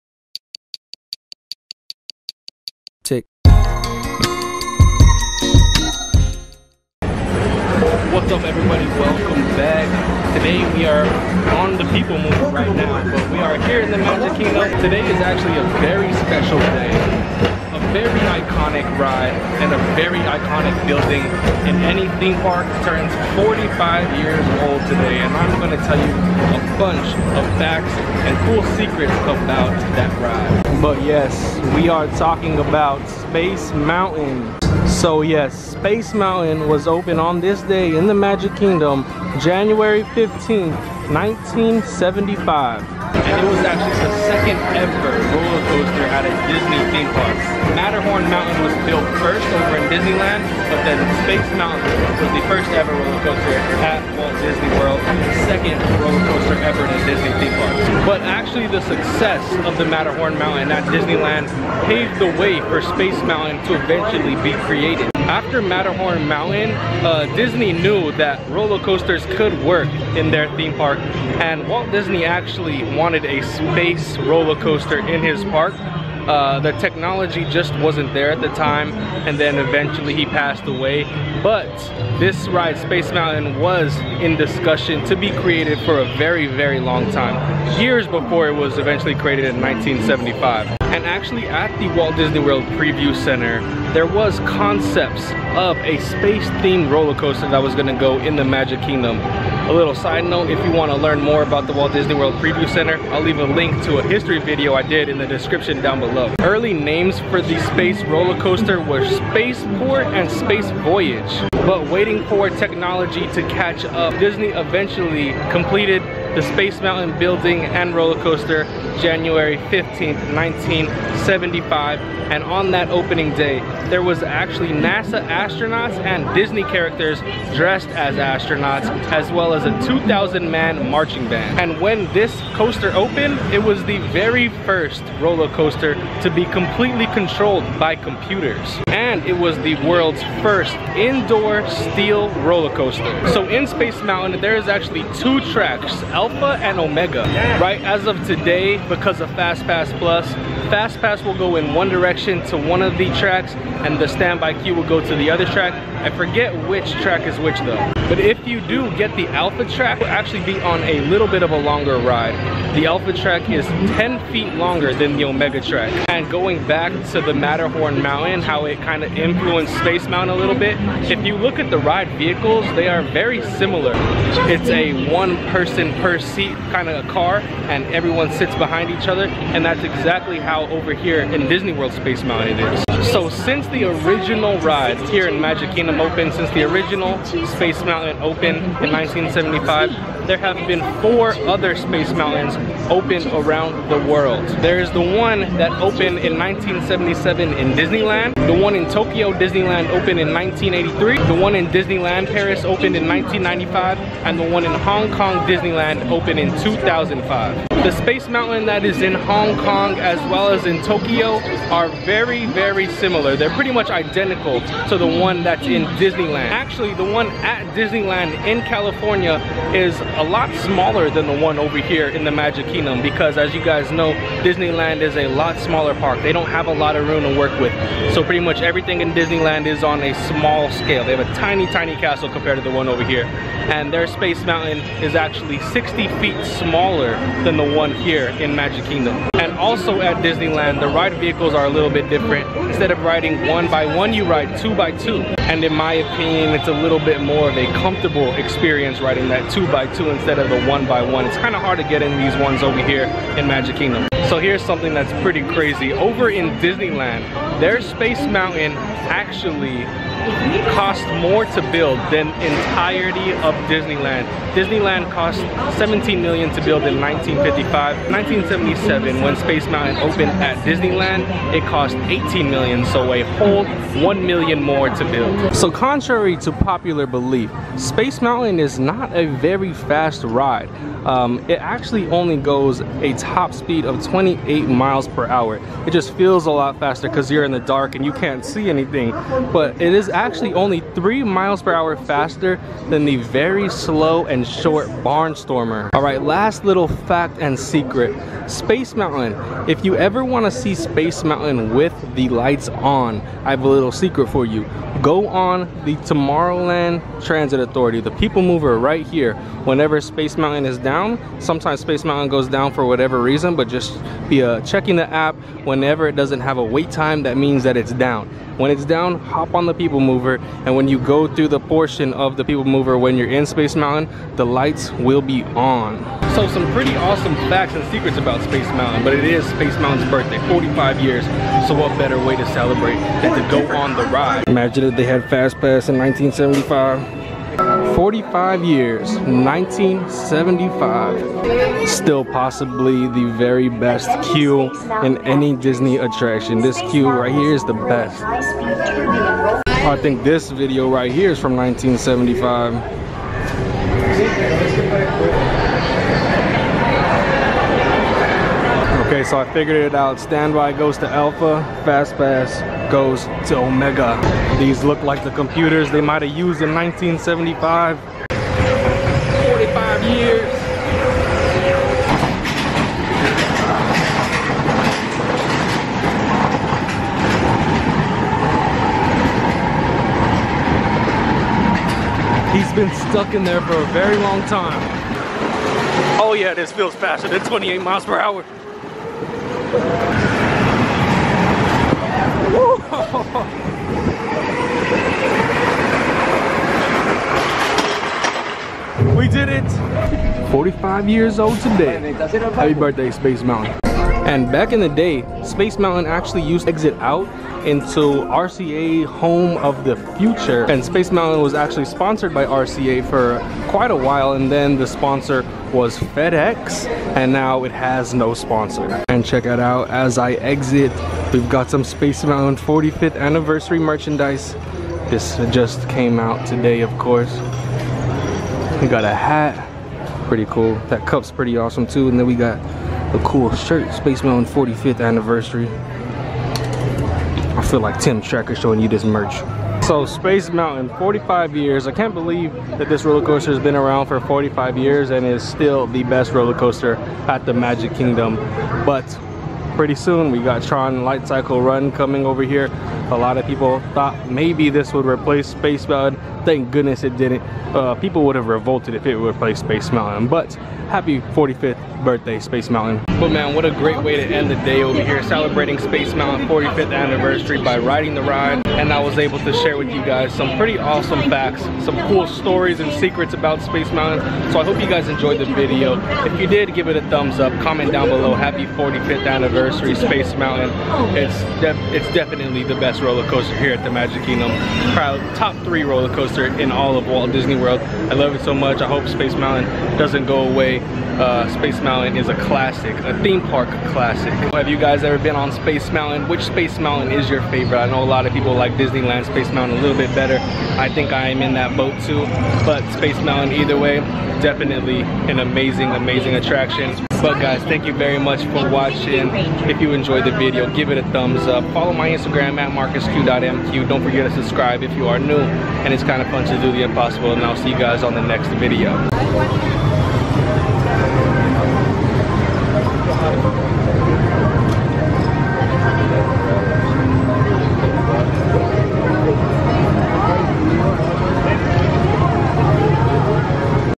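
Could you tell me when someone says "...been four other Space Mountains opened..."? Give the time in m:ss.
3:10.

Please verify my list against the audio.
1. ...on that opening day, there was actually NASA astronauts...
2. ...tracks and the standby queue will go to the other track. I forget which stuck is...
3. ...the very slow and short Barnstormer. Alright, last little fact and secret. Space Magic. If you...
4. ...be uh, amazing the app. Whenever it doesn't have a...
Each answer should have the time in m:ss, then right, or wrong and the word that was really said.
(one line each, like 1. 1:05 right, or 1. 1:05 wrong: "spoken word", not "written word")
1. 2:02 right
2. 2:33 wrong: "track", not "stuck"
3. 4:53 wrong: "Mountain", not "Magic"
4. 5:14 wrong: "checking", not "amazing".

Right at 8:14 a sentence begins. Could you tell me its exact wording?
Have you guys ever been on Space Mountain?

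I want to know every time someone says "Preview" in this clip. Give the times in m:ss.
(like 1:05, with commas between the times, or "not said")
1:32, 1:42.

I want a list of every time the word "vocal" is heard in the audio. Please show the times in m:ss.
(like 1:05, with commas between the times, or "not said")
not said.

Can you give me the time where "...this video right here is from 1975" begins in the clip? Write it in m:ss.
5:50.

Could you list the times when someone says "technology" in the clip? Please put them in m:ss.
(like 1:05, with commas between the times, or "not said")
1:16, 1:52.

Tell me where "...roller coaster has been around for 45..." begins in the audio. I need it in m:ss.
7:23.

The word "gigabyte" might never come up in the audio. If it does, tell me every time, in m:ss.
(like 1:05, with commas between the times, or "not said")
not said.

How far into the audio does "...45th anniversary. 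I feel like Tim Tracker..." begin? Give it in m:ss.
7:14.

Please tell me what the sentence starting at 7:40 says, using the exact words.
But happy 45th birthday, Space Mountain.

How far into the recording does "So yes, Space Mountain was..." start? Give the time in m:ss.
0:35.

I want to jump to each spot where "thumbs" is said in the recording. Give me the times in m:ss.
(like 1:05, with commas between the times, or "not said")
7:57, 8:31.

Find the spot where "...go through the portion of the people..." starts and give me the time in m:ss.
5:20.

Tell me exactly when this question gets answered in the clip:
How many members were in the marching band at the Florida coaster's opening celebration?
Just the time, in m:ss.
2:09.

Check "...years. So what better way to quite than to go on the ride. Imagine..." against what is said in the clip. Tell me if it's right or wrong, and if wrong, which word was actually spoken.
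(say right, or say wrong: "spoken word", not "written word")
wrong: "celebrate", not "quite".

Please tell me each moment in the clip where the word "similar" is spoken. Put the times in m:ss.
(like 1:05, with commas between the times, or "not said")
2:53, 3:32.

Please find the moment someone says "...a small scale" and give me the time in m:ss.
3:50.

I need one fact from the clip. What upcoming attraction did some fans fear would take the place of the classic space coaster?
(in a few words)
Tron Light Cycle Run.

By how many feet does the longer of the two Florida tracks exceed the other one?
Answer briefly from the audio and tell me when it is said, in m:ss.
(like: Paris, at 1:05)
10 feet, at 2:43.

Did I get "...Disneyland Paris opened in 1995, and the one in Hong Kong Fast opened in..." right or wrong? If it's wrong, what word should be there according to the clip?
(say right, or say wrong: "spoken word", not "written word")
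wrong: "Disneyland", not "Fast".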